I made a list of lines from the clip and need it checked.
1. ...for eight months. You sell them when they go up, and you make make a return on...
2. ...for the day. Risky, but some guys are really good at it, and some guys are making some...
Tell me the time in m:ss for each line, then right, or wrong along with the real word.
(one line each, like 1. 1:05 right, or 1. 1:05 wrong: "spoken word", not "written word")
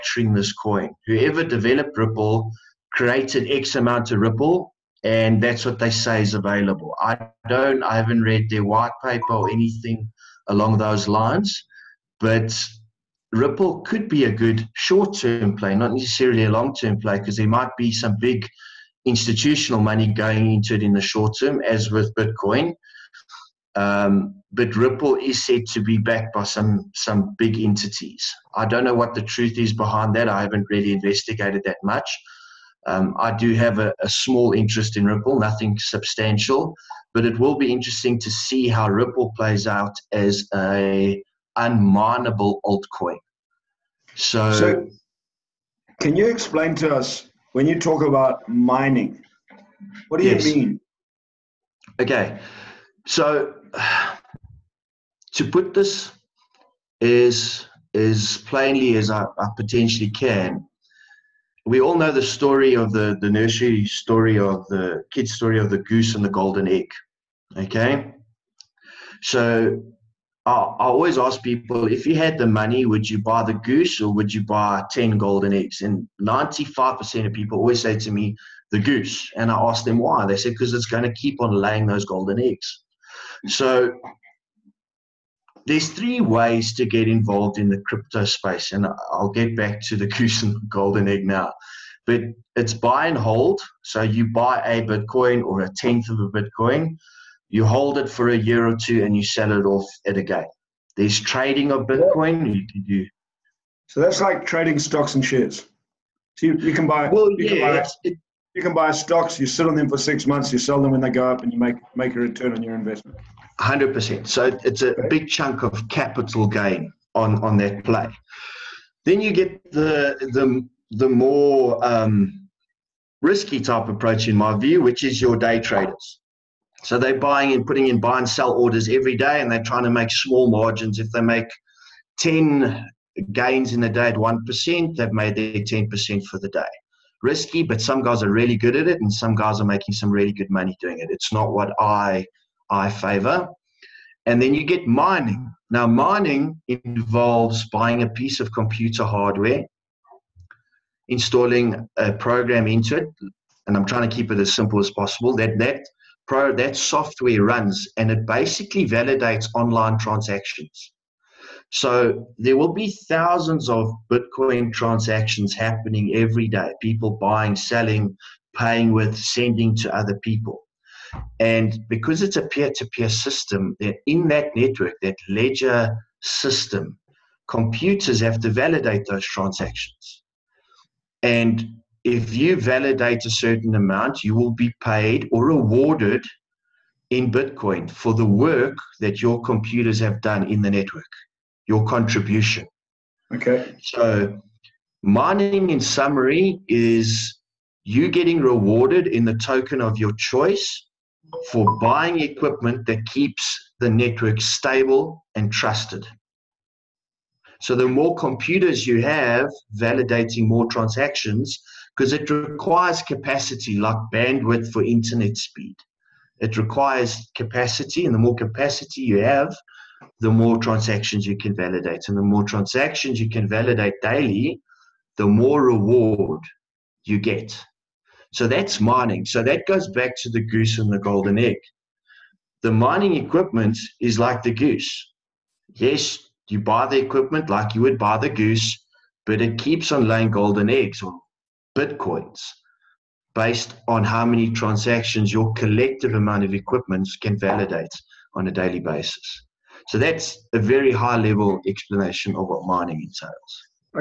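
1. 1:49 wrong: "six", not "eight"
2. 2:16 right.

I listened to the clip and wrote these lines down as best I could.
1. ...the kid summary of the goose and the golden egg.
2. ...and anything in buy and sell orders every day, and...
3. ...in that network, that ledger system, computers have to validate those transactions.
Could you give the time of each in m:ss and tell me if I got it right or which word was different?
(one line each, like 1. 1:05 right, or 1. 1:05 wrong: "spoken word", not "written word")
1. 1:04 wrong: "story", not "summary"
2. 2:07 wrong: "putting", not "anything"
3. 2:54 right.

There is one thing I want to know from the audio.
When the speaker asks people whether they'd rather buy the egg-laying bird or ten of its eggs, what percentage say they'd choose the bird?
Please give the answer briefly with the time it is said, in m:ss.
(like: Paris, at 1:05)
95%, at 1:16.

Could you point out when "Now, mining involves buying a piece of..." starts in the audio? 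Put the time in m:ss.
2:25.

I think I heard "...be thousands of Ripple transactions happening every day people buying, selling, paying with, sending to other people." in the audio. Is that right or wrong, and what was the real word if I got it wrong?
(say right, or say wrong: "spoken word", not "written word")
wrong: "Bitcoin", not "Ripple".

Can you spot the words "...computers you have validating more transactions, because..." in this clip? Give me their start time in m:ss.
3:28.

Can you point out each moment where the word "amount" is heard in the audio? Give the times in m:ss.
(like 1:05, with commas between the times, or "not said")
0:03, 3:03, 4:06.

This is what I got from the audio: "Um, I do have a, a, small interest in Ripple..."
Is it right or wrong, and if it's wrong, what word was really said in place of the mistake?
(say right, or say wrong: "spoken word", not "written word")
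right.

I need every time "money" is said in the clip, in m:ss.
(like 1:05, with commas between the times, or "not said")
0:19, 1:12, 2:20.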